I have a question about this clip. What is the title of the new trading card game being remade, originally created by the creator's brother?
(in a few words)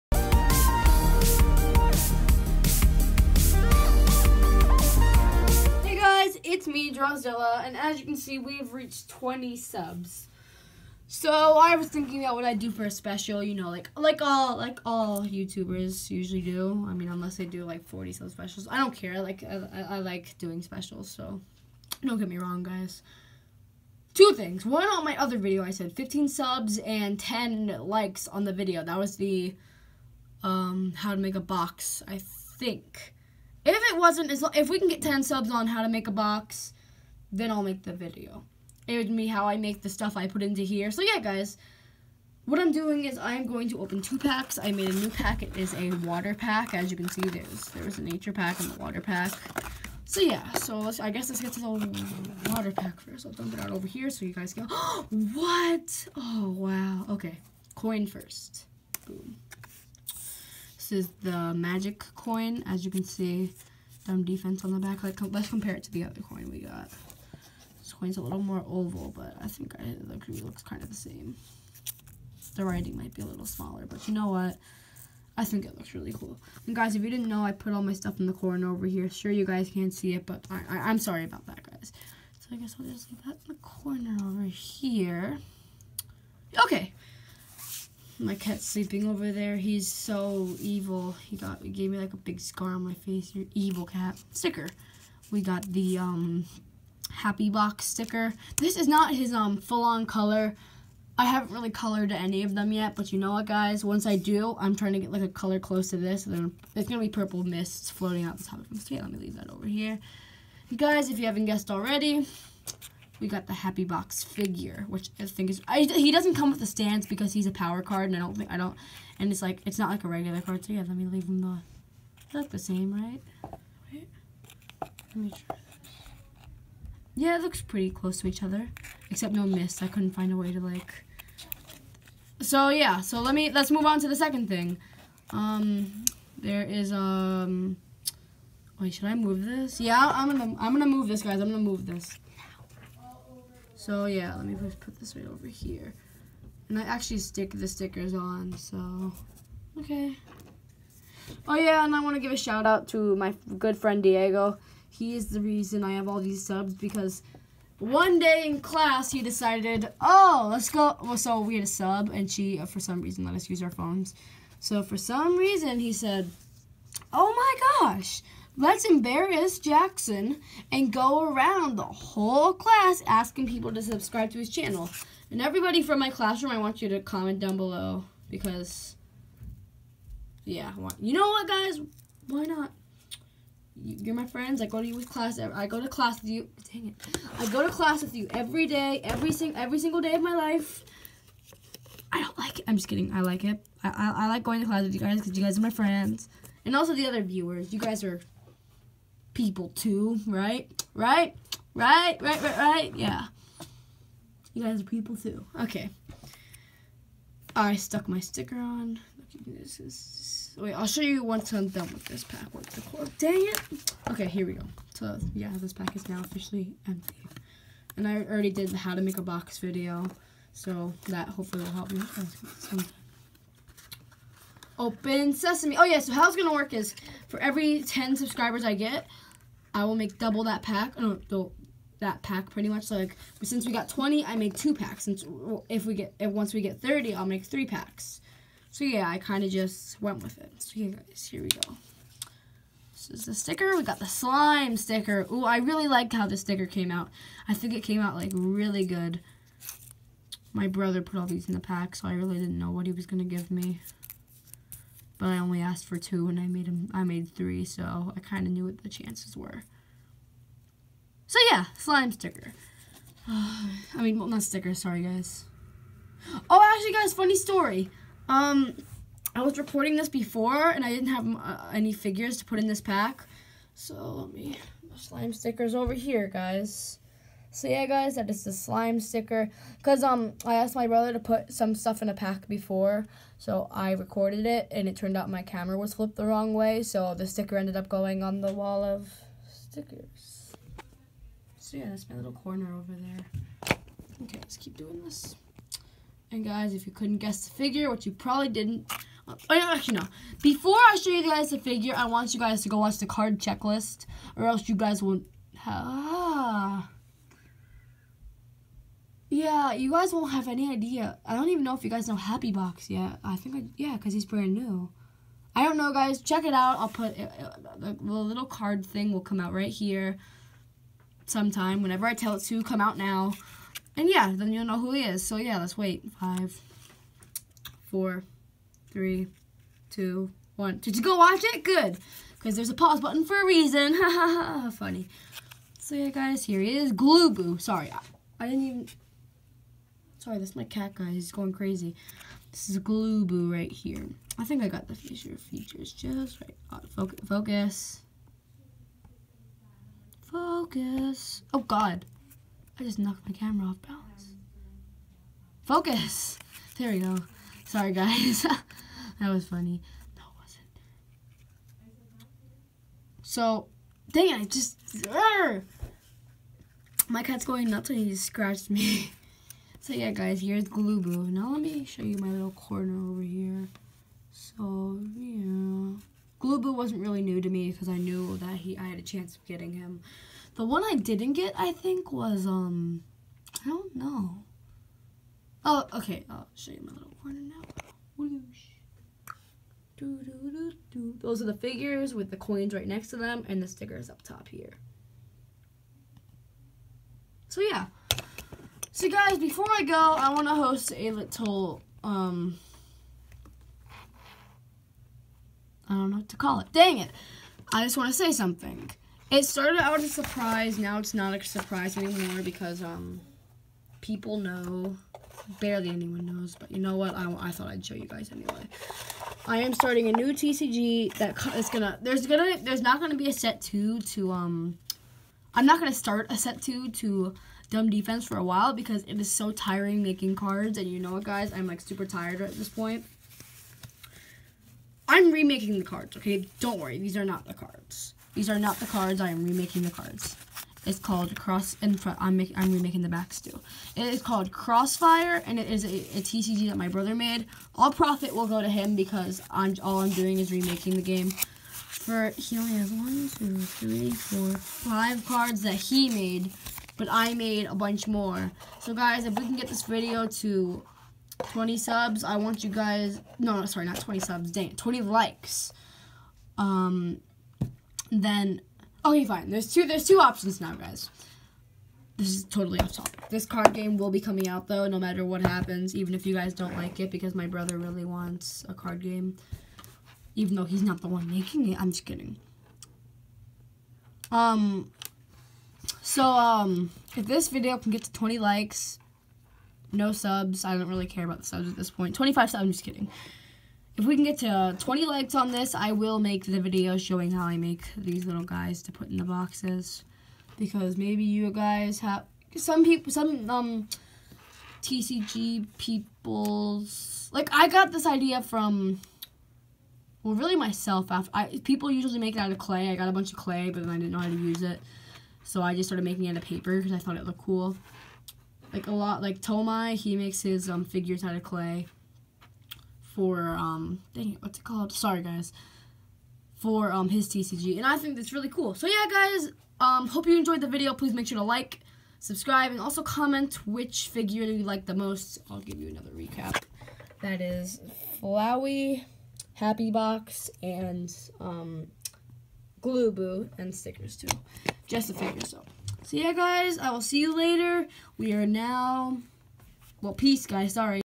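Crossfire.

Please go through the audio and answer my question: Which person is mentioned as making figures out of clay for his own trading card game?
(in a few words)
Tomai.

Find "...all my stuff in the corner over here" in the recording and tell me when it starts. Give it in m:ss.
1:17.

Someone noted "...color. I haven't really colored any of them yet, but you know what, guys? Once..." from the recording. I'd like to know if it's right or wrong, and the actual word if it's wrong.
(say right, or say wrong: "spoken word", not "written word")
right.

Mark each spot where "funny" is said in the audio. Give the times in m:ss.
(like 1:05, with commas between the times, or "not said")
4:27, 5:34, 5:59.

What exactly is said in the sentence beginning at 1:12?
The writing might be a little smaller, but you know what?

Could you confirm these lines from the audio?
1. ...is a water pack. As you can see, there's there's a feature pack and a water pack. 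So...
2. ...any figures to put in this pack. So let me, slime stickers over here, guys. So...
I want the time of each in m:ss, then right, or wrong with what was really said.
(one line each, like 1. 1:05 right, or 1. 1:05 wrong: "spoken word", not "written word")
1. 0:45 wrong: "nature", not "feature"
2. 4:31 right.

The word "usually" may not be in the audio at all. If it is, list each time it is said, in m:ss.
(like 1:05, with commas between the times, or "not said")
0:16, 8:31.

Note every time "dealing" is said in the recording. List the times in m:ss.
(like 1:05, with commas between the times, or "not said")
not said.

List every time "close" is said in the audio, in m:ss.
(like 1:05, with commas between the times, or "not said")
1:45, 2:07.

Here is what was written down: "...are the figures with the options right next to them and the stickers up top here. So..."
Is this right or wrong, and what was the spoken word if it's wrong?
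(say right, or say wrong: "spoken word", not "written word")
wrong: "coins", not "options".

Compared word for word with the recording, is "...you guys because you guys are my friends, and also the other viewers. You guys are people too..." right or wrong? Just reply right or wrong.
right.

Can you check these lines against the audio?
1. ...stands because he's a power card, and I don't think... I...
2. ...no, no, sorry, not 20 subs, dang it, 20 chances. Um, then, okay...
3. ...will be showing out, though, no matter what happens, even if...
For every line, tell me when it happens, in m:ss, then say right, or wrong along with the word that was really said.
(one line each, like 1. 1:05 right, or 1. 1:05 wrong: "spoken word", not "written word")
1. 1:56 right
2. 7:43 wrong: "likes", not "chances"
3. 7:53 wrong: "coming", not "showing".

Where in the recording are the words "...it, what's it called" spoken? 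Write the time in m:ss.
8:44.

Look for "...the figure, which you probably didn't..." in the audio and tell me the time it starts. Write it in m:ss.
4:57.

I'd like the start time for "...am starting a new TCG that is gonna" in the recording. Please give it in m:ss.
6:59.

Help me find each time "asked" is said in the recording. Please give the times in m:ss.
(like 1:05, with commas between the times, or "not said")
4:15, 4:40.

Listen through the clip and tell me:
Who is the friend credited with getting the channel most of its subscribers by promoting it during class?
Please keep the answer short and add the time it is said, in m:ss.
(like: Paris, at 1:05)
Diego, at 2:34.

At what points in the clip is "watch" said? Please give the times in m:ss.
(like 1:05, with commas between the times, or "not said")
5:02, 5:31.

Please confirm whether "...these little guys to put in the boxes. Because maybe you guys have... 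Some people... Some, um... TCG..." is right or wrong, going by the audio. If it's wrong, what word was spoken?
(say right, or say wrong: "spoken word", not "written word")
right.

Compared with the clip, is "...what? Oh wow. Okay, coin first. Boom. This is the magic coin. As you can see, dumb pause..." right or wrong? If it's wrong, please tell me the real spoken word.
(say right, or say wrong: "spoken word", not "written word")
wrong: "defense", not "pause".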